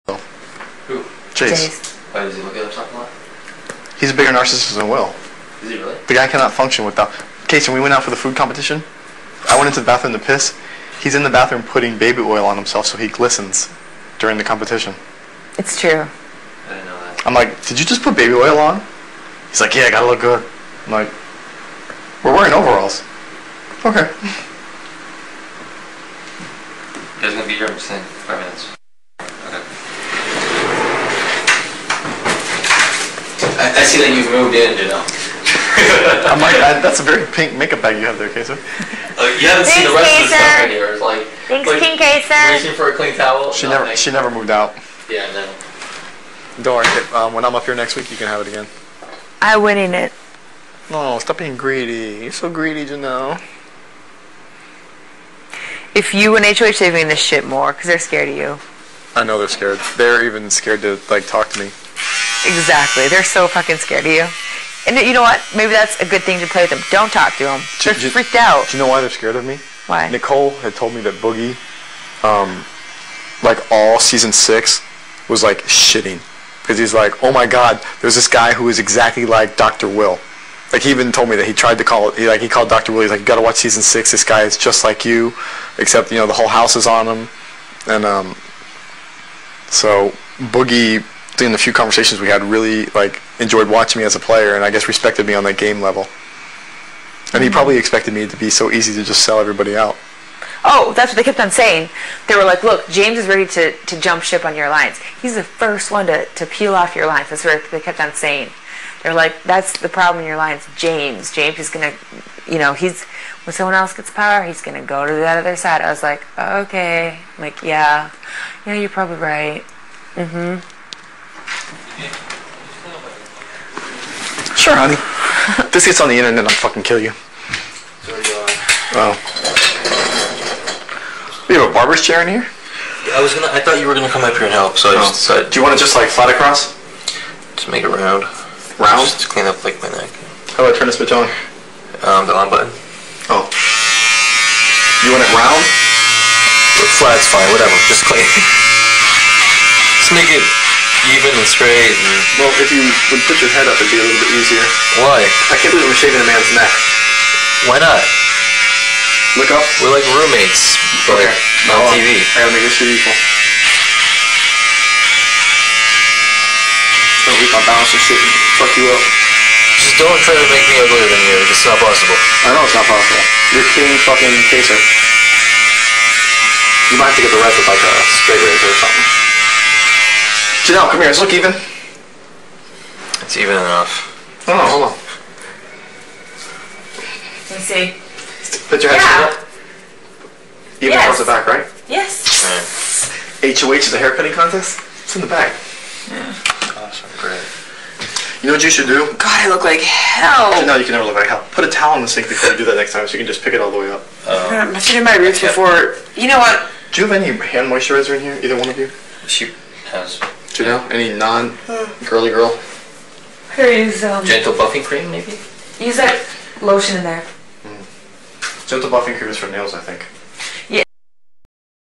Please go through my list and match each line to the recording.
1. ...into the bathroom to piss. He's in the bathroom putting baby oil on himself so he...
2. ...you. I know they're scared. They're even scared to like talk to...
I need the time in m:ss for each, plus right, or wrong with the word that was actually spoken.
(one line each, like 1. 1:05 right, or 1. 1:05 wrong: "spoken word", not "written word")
1. 0:09 right
2. 0:58 right.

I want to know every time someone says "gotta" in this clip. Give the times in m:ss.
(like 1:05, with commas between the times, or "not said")
0:19, 1:23, 2:42.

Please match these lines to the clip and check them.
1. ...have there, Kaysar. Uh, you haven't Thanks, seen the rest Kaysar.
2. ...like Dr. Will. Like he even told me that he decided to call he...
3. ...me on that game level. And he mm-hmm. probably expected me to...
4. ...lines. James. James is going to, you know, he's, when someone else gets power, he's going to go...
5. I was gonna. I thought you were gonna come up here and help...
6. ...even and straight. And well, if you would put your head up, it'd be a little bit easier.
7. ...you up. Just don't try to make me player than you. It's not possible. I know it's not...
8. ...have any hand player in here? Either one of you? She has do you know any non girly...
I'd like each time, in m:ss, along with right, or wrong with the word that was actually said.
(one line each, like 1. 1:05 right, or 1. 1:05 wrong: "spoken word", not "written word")
1. 0:38 right
2. 1:19 wrong: "tried", not "decided"
3. 1:35 right
4. 1:50 right
5. 2:13 right
6. 2:31 right
7. 2:48 wrong: "uglier", not "player"
8. 3:27 wrong: "moisturizer", not "player".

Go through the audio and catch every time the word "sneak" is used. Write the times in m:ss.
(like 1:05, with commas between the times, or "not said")
not said.